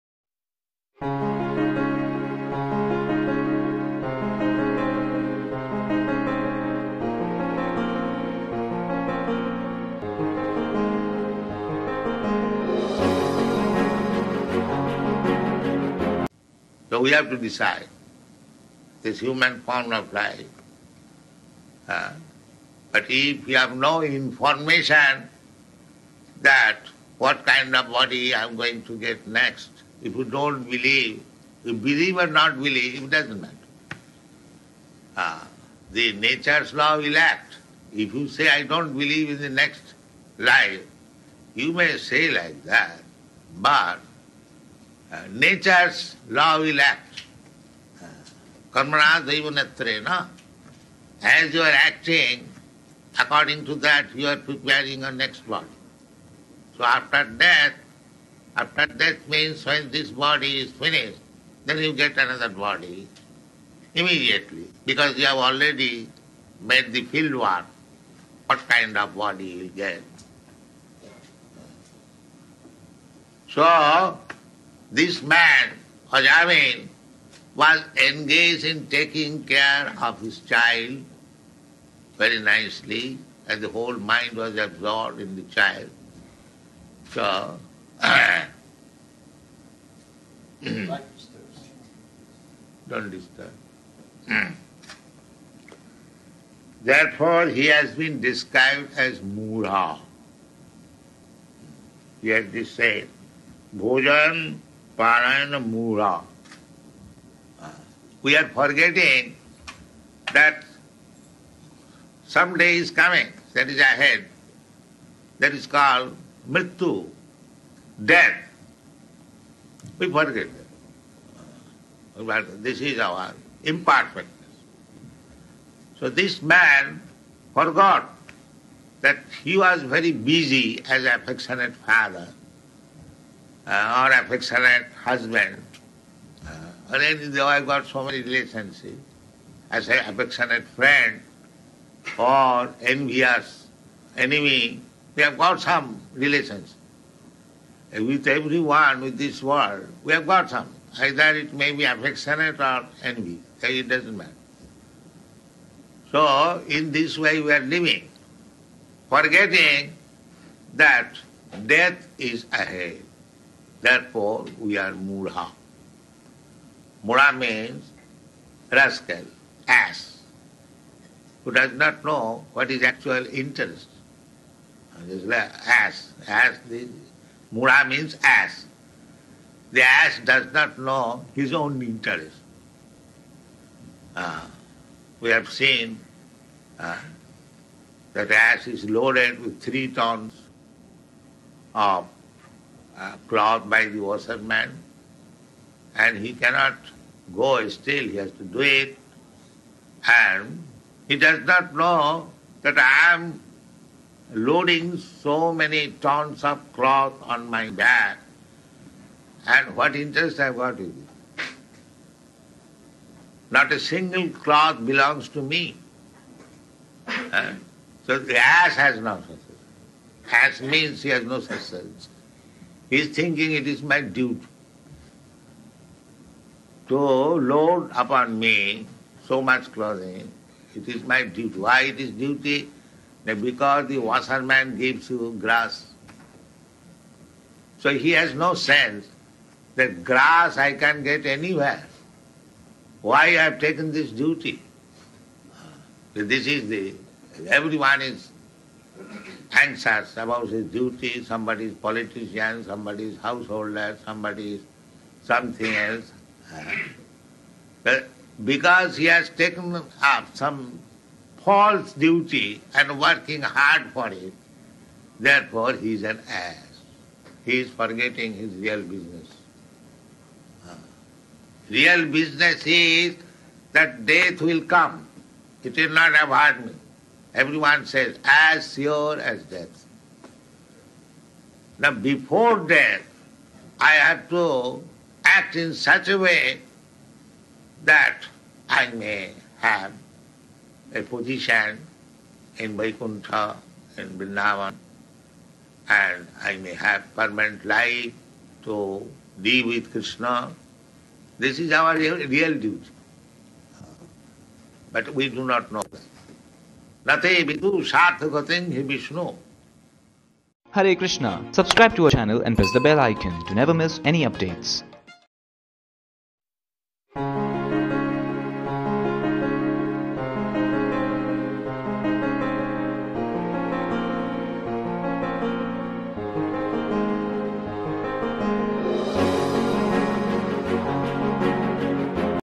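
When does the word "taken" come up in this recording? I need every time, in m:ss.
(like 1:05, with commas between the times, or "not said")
4:03, 4:19.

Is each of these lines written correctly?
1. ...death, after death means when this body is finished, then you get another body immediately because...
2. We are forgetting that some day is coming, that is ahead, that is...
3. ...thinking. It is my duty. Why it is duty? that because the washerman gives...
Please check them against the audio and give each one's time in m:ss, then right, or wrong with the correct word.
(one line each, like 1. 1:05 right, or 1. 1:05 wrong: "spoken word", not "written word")
1. 0:57 right
2. 1:48 right
3. 3:49 wrong: "clothing", not "thinking".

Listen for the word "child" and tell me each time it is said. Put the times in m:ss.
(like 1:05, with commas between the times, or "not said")
1:20, 1:25.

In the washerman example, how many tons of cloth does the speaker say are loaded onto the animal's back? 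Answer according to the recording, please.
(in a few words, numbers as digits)
3 tons.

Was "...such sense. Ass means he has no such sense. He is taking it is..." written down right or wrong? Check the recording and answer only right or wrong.
wrong.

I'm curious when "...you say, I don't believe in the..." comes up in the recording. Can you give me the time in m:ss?
0:38.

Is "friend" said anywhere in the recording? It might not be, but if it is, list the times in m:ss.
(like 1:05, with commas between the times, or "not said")
2:20.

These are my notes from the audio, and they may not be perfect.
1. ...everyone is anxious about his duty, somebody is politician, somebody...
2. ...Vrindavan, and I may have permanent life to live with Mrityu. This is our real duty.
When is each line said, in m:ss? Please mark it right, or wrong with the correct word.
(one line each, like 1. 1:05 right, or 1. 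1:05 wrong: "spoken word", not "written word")
1. 4:07 right
2. 4:54 wrong: "Krishna", not "Mrityu".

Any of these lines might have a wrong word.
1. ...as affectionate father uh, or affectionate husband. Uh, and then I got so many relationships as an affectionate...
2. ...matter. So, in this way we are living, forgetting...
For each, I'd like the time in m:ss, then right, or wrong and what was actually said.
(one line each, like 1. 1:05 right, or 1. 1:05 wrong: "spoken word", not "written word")
1. 2:10 right
2. 2:34 right.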